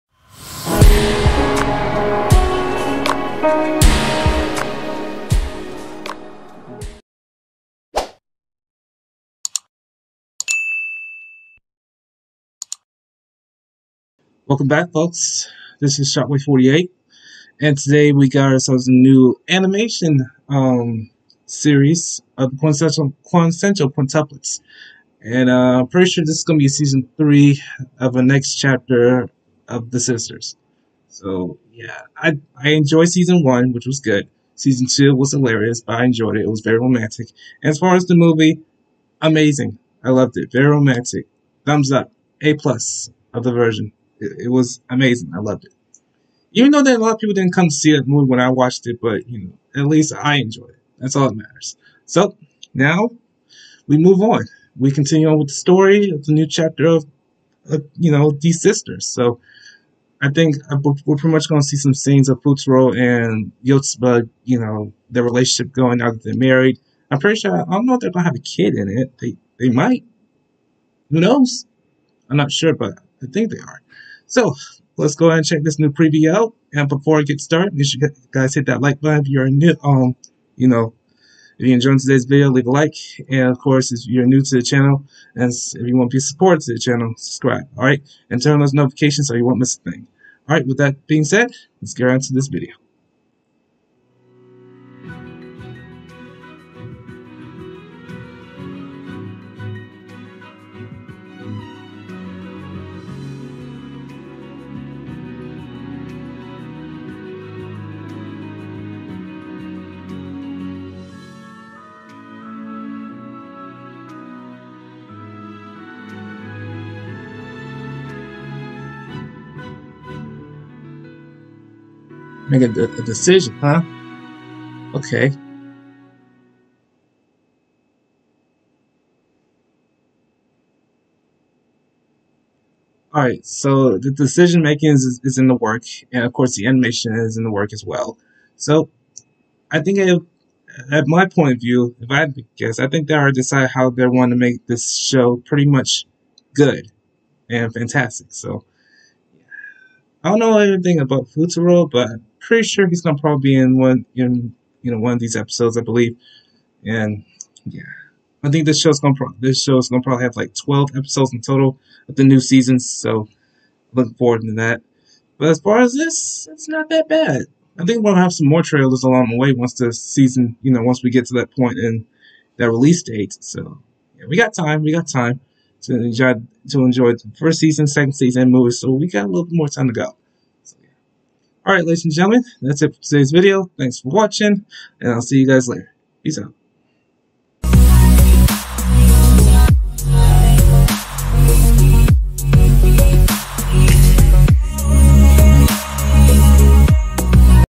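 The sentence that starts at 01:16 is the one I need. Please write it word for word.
And before I get started, you guys hit that like button if you're new.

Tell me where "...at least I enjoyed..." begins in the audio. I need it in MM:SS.
00:49.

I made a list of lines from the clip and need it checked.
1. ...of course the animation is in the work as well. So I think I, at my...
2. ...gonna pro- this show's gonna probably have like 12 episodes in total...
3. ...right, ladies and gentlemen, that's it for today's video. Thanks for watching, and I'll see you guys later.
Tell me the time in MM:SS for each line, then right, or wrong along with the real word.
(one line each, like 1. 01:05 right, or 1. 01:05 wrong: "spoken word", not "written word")
1. 02:16 right
2. 02:38 right
3. 03:01 right.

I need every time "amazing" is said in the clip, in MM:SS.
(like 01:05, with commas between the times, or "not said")
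00:39, 00:44.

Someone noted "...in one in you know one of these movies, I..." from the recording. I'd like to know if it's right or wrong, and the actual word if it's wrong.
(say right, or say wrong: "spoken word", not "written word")
wrong: "episodes", not "movies".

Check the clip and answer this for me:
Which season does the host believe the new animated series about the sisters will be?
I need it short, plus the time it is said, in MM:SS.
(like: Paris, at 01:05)
season three, at 00:26.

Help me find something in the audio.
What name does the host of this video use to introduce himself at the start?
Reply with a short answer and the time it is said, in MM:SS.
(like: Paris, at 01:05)
Shockwave48, at 00:16.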